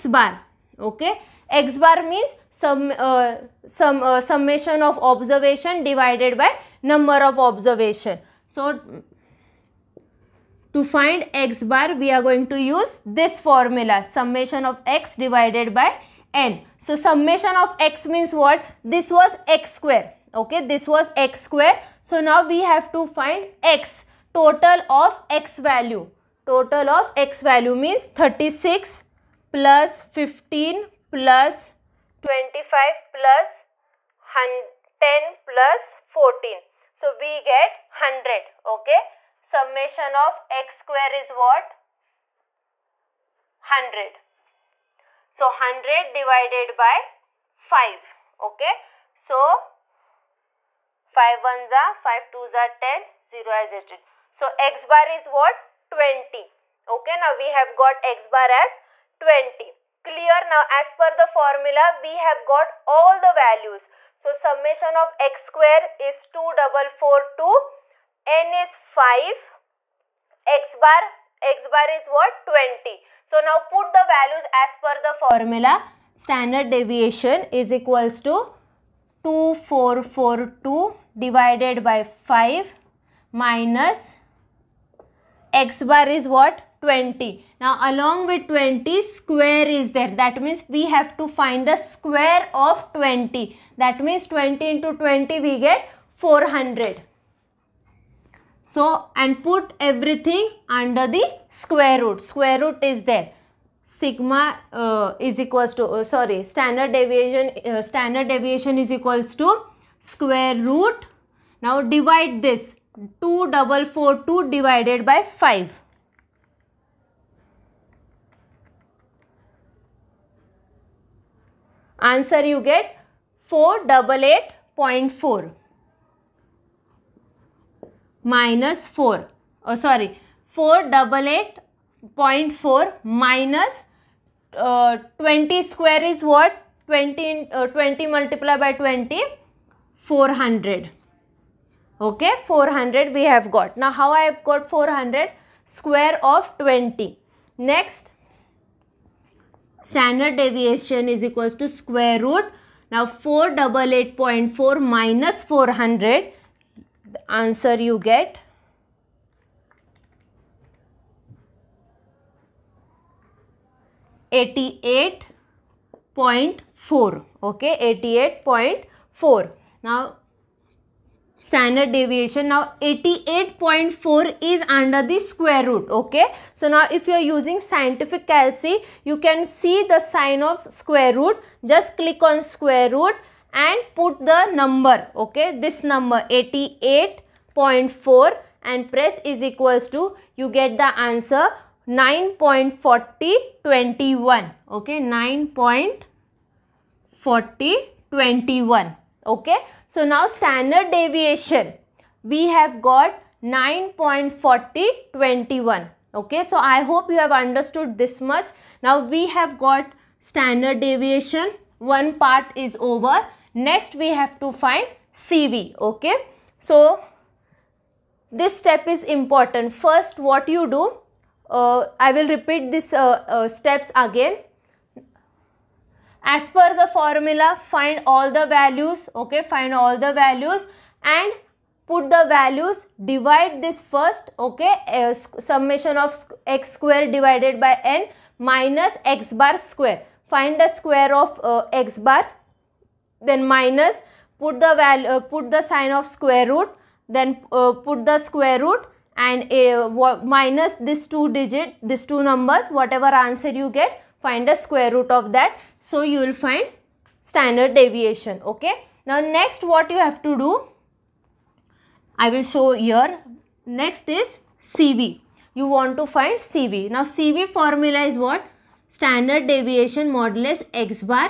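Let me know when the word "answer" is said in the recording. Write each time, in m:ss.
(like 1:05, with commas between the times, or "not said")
2:01, 2:37, 3:10, 4:13.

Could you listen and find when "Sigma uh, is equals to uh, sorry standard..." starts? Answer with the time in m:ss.
1:43.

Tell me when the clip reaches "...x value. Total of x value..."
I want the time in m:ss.
0:25.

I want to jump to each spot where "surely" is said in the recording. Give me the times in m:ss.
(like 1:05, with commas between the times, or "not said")
not said.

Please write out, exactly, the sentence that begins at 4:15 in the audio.
So you will find standard deviation.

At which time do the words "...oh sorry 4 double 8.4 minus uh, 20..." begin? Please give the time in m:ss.
2:09.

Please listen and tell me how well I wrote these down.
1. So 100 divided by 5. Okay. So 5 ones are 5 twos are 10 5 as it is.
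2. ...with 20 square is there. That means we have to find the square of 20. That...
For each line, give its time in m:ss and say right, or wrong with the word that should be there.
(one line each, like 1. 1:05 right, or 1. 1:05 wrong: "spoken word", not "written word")
1. 0:45 wrong: "0", not "5"
2. 1:28 right.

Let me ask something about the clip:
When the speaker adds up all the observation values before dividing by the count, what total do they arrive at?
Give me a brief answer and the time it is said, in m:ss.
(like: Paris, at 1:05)
100, at 0:36.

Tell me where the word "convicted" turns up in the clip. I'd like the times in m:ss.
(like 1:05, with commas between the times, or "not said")
not said.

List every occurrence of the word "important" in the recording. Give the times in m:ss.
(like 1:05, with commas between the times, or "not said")
3:39.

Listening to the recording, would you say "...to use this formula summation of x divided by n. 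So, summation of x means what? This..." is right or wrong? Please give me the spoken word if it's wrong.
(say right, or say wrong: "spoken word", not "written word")
right.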